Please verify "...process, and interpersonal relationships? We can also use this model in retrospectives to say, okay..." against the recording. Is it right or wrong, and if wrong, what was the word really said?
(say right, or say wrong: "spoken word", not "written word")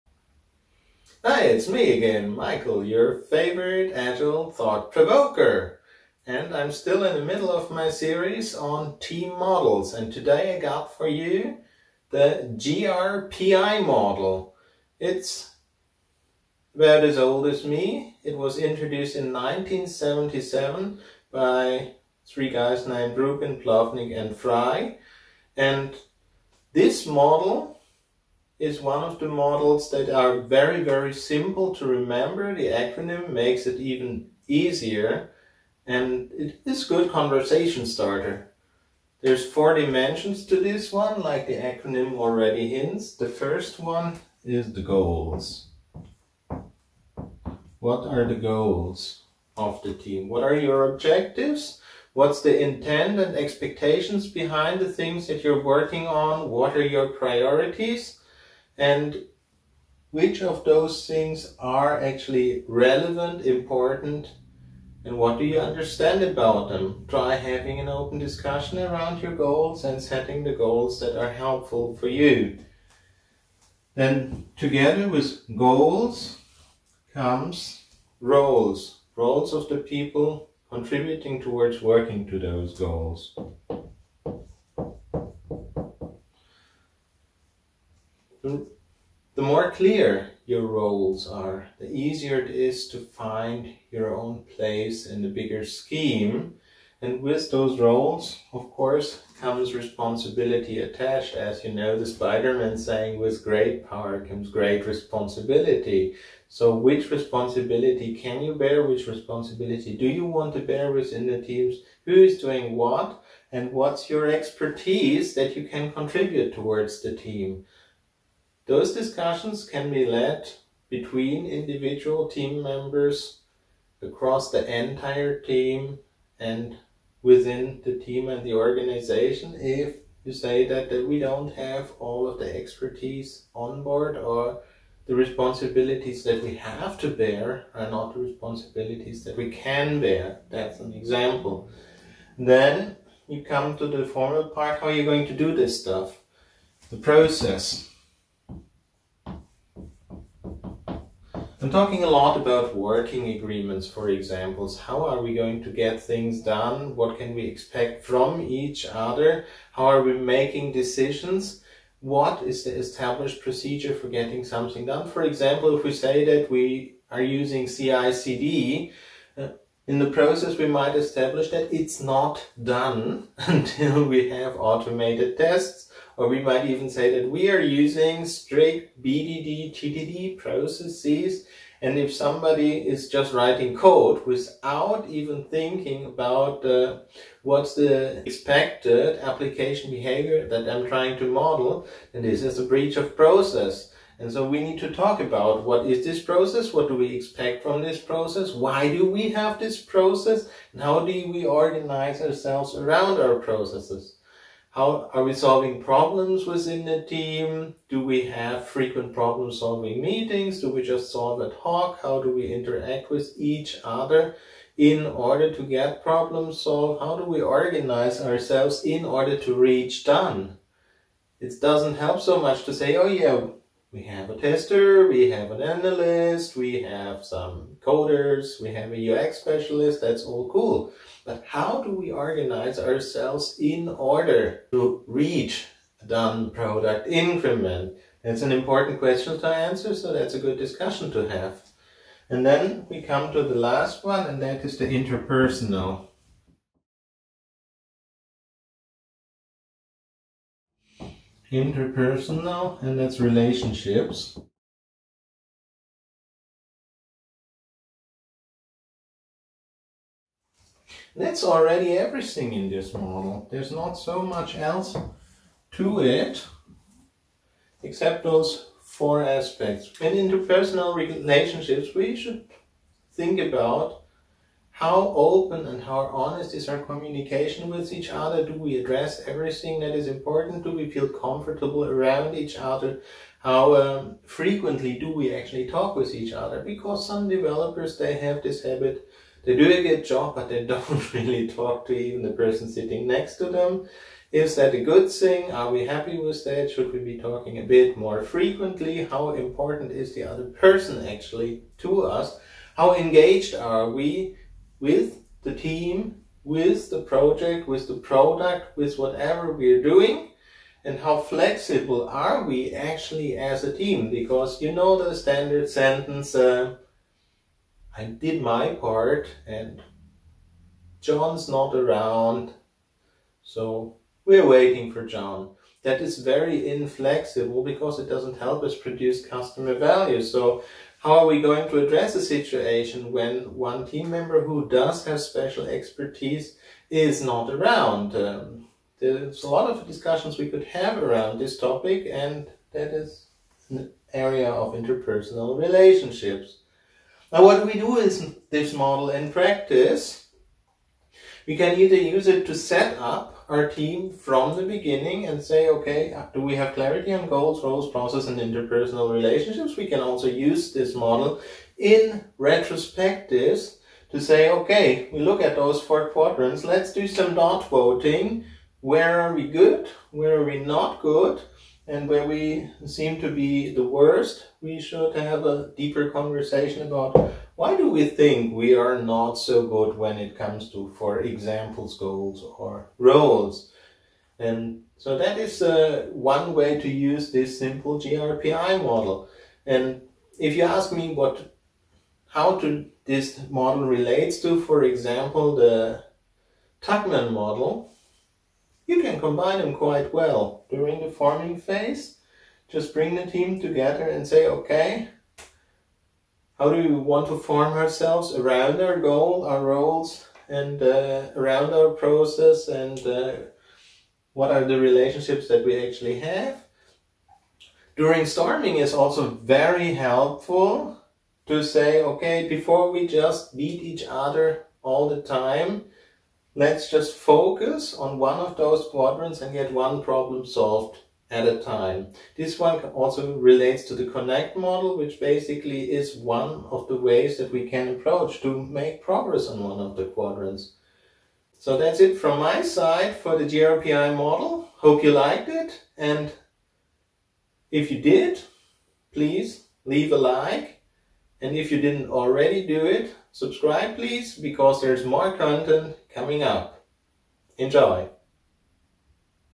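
right.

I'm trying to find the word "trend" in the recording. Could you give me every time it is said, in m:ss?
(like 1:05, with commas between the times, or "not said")
not said.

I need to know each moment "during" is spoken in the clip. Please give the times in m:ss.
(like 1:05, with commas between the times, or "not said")
6:40, 6:57.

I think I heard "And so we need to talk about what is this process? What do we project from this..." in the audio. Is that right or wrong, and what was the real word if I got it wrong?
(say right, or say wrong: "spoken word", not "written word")
wrong: "expect", not "project".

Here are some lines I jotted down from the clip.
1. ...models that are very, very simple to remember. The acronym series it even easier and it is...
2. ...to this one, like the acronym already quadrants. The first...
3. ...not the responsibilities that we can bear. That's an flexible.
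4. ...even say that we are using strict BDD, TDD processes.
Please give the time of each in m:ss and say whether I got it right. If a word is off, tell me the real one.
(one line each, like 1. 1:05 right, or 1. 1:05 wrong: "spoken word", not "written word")
1. 0:29 wrong: "makes", not "series"
2. 0:40 wrong: "hints", not "quadrants"
3. 2:17 wrong: "example", not "flexible"
4. 2:56 right.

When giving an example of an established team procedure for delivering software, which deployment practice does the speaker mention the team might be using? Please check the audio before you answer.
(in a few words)
CI/CD.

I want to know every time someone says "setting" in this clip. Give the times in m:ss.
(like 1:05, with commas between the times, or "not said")
1:10.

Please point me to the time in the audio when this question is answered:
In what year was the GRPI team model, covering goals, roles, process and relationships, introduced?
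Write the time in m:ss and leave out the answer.
0:19.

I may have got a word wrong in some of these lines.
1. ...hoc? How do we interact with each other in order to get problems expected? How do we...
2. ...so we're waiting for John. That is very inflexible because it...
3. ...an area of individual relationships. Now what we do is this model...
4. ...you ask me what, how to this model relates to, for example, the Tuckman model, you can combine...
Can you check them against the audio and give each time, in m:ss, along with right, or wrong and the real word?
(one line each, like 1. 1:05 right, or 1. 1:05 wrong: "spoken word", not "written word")
1. 3:31 wrong: "solved", not "expected"
2. 5:23 right
3. 5:43 wrong: "interpersonal", not "individual"
4. 6:30 right.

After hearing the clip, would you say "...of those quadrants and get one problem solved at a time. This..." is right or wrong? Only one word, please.
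right.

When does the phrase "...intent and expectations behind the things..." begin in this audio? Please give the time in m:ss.
0:52.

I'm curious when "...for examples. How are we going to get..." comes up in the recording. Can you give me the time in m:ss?
2:33.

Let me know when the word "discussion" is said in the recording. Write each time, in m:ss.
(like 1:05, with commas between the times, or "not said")
1:08, 1:58, 4:00, 5:39.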